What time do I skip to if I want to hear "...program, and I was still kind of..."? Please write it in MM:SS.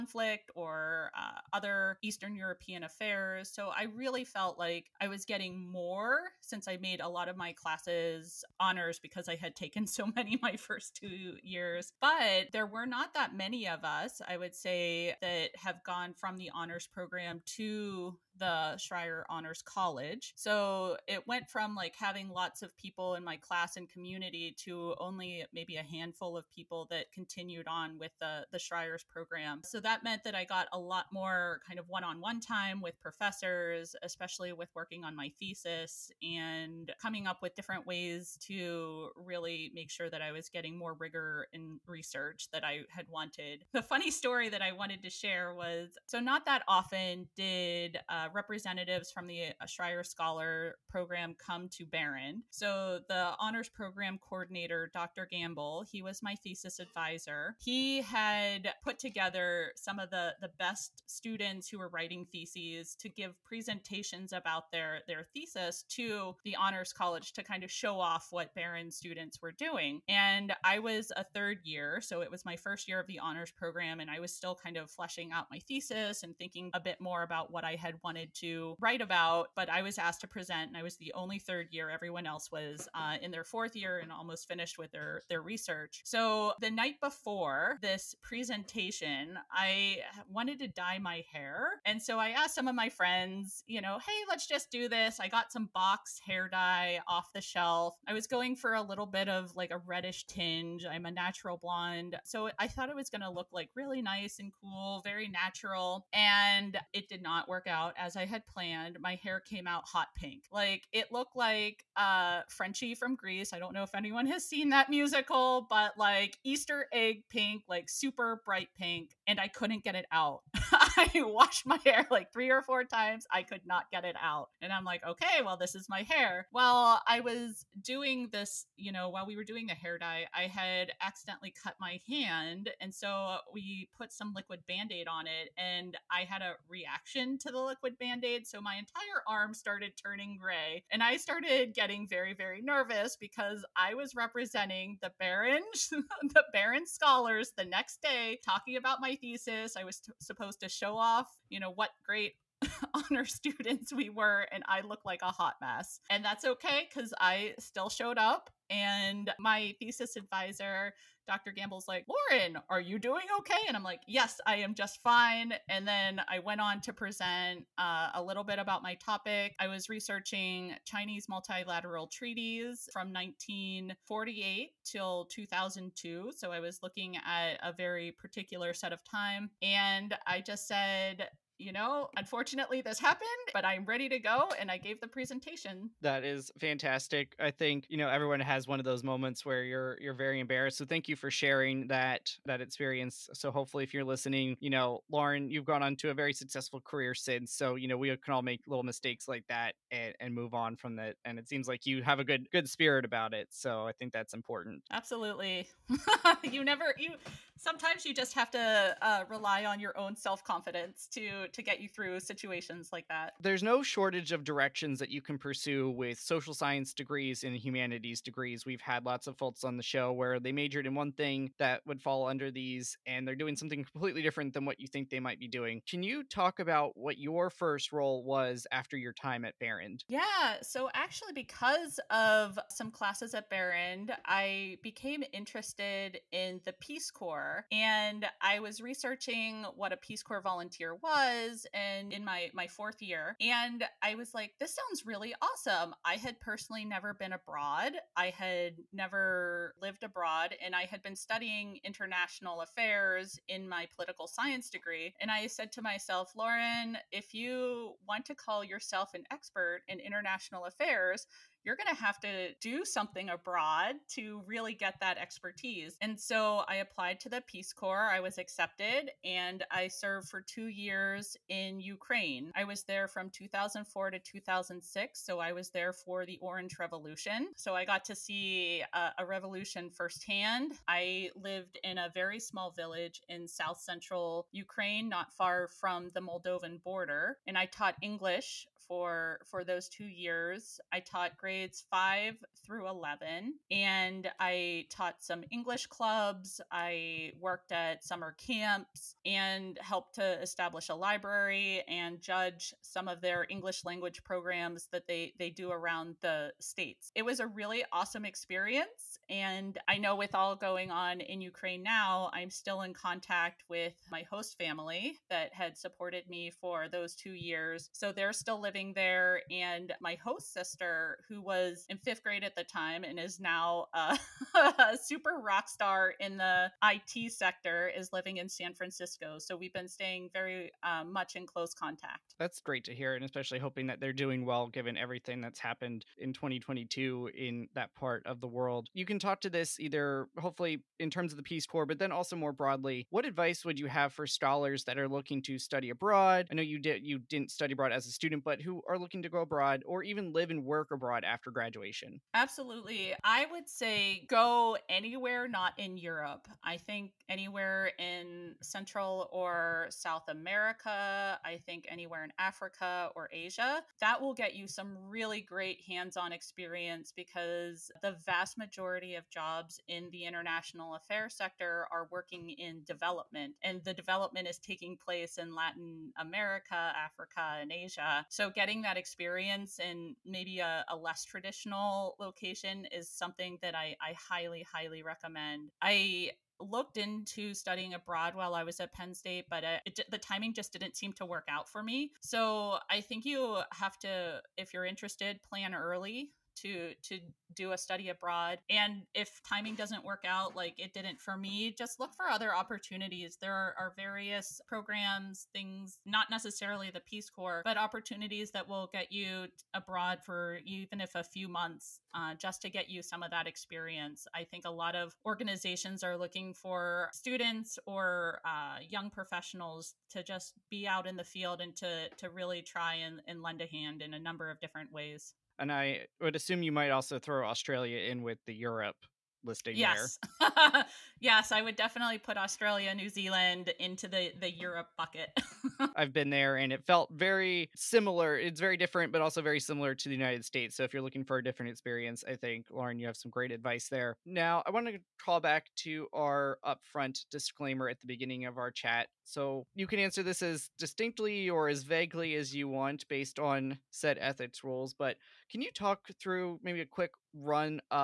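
01:13.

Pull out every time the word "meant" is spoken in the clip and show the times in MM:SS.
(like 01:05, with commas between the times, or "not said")
00:30.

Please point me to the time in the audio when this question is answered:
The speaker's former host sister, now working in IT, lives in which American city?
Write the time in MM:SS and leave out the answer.
05:28.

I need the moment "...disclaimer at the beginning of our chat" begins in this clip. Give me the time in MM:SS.
07:27.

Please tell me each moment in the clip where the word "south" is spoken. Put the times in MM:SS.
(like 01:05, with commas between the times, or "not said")
04:43, 05:59.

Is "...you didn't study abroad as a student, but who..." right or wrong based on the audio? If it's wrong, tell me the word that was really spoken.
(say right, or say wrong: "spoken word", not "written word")
right.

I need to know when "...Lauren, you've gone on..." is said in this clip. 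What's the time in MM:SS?
03:15.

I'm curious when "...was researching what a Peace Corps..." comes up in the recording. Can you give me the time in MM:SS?
03:58.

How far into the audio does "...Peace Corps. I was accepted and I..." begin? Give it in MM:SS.
04:27.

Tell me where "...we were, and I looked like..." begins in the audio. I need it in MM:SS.
02:33.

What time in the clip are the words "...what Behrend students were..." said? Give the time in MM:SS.
01:08.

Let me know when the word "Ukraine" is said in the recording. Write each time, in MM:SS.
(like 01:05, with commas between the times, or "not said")
04:31, 04:44, 05:11.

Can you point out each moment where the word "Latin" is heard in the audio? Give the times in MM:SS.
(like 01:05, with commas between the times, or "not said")
06:15.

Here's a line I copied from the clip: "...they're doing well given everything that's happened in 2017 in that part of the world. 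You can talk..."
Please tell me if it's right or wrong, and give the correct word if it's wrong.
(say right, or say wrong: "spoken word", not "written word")
wrong: "2022", not "2017".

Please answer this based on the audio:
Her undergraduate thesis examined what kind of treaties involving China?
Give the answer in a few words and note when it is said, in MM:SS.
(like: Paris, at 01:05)
multilateral treaties, at 02:51.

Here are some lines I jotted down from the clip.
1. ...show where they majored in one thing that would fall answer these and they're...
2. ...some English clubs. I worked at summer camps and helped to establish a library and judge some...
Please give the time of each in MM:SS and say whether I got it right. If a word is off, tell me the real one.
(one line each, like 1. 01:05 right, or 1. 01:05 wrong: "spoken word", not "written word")
1. 03:39 wrong: "under", not "answer"
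2. 04:55 right.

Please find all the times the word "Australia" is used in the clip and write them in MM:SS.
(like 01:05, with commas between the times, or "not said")
07:07, 07:12.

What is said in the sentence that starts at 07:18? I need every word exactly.
It's very different but also very similar to the United States.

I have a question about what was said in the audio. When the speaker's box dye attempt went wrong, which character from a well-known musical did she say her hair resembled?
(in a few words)
Frenchie.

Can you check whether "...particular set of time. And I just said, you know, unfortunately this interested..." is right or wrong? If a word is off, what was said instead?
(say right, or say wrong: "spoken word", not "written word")
wrong: "happened", not "interested".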